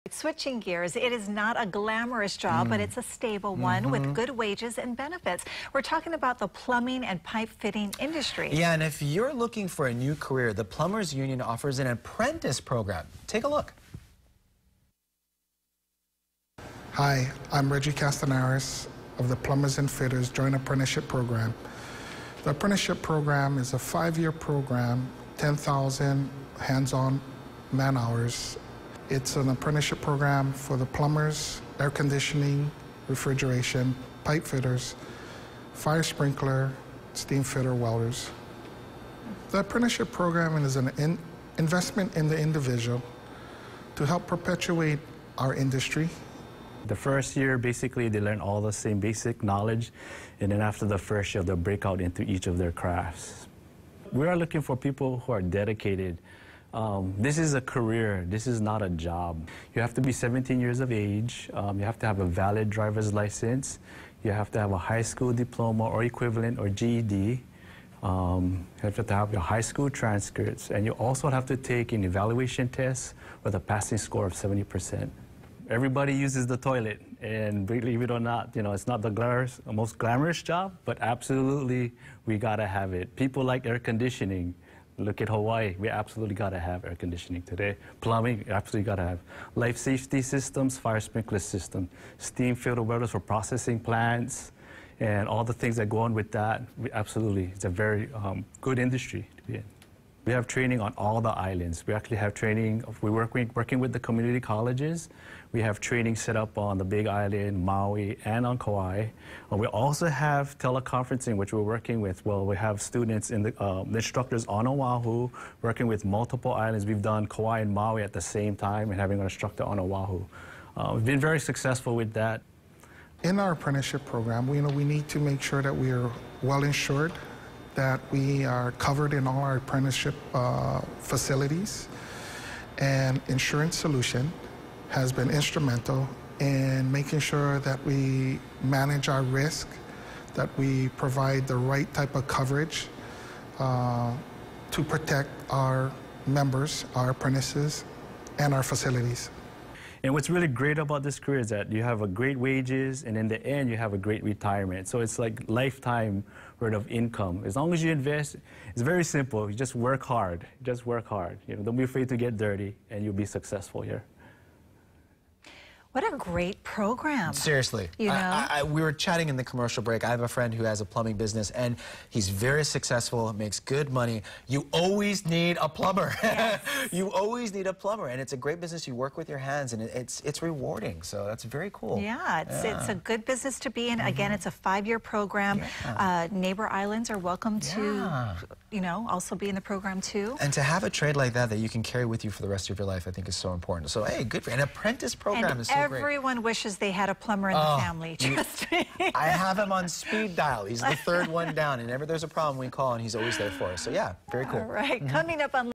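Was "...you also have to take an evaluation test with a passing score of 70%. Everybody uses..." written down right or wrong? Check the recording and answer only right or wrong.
right.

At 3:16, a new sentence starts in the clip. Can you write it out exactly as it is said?
wishes they had a plumber in oh, the family.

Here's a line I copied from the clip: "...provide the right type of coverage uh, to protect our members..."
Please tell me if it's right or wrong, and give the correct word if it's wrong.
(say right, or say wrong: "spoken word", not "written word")
right.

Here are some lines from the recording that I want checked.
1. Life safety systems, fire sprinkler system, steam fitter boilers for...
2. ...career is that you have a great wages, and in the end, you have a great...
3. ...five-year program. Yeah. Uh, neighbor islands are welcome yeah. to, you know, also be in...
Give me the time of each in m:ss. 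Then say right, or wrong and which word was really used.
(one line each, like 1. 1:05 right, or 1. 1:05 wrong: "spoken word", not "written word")
1. 1:29 right
2. 2:31 right
3. 3:04 right.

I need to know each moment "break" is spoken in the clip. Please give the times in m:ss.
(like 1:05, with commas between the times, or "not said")
0:51, 2:49.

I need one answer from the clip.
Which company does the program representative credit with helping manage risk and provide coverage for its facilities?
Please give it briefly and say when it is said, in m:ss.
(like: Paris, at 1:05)
Insurance Solution, at 2:13.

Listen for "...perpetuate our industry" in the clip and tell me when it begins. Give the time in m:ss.
0:44.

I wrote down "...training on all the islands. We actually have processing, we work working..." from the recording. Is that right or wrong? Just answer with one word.
wrong.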